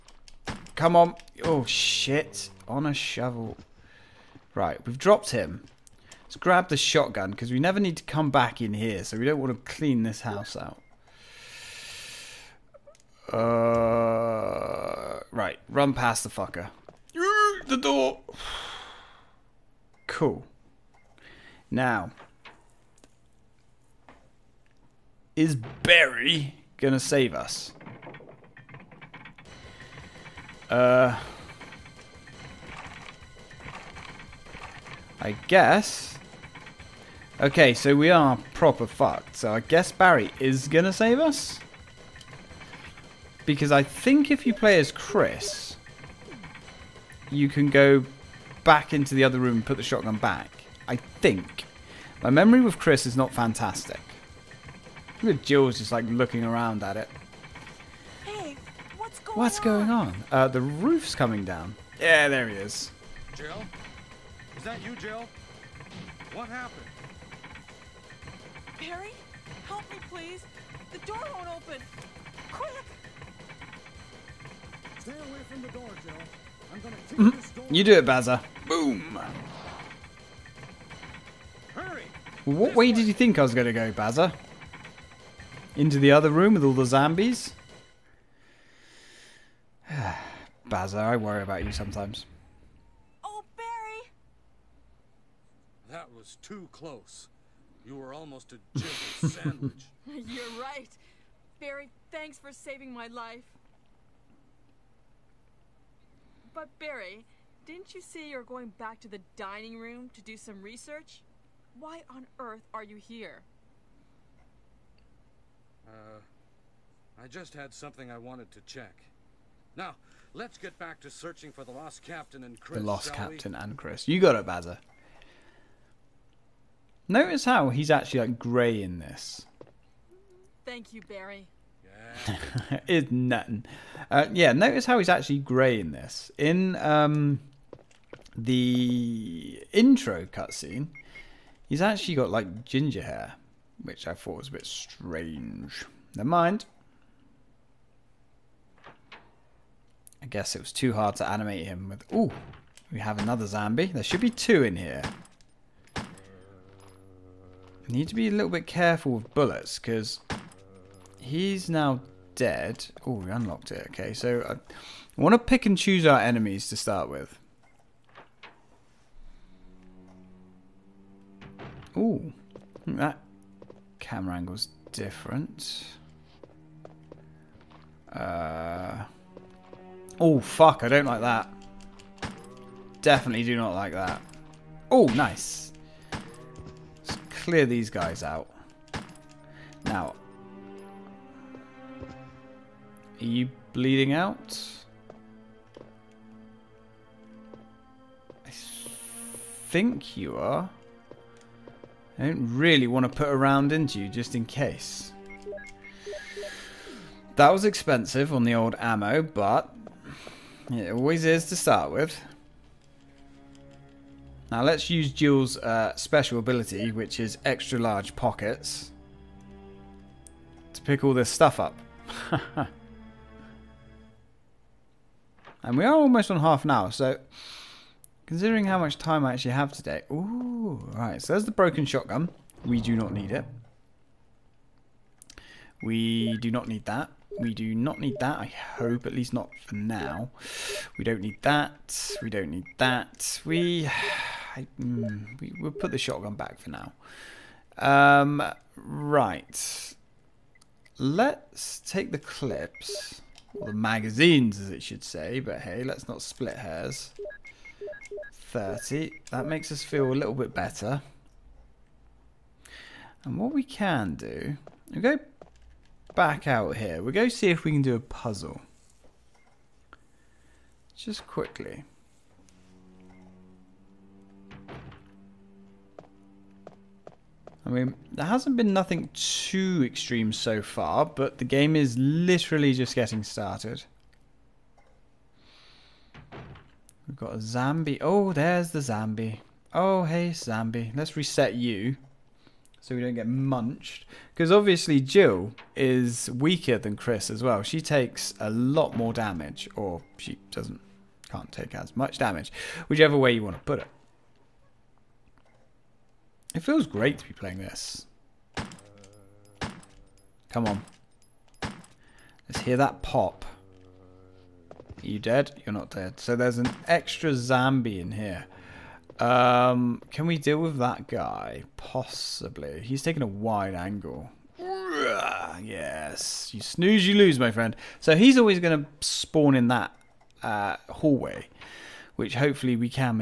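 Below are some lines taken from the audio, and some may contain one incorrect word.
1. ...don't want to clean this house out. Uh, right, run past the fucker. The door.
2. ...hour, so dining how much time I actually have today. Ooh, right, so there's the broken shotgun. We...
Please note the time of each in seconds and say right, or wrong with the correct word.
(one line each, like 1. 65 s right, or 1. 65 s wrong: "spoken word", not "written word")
1. 9 s right
2. 226 s wrong: "considering", not "dining".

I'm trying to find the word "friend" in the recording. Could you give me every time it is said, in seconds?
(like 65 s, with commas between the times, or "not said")
327 s.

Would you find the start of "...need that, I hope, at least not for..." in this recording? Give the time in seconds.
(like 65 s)
237 s.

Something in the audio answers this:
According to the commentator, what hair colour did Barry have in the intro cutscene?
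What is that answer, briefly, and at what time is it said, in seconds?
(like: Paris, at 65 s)
Ginger, at 142 s.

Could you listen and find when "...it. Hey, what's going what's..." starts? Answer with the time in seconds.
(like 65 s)
56 s.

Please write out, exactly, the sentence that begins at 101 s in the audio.
Barry, thanks for saving my life.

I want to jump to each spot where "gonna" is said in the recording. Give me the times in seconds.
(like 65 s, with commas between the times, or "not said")
26 s, 76 s, 83 s.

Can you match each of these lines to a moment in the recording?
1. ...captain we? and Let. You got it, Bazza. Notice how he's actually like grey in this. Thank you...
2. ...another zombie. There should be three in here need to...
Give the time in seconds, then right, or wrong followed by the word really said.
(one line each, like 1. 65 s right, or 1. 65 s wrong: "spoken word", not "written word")
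1. 123 s wrong: "Chris", not "Let"
2. 153 s wrong: "two", not "three".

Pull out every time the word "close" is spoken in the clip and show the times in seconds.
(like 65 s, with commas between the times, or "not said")
96 s.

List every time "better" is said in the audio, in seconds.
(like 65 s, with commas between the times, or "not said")
260 s.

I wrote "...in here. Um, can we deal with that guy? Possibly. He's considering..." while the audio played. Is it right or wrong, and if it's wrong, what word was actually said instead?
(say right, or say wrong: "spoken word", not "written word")
wrong: "taking", not "considering".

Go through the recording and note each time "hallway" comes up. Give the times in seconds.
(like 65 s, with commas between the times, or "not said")
330 s.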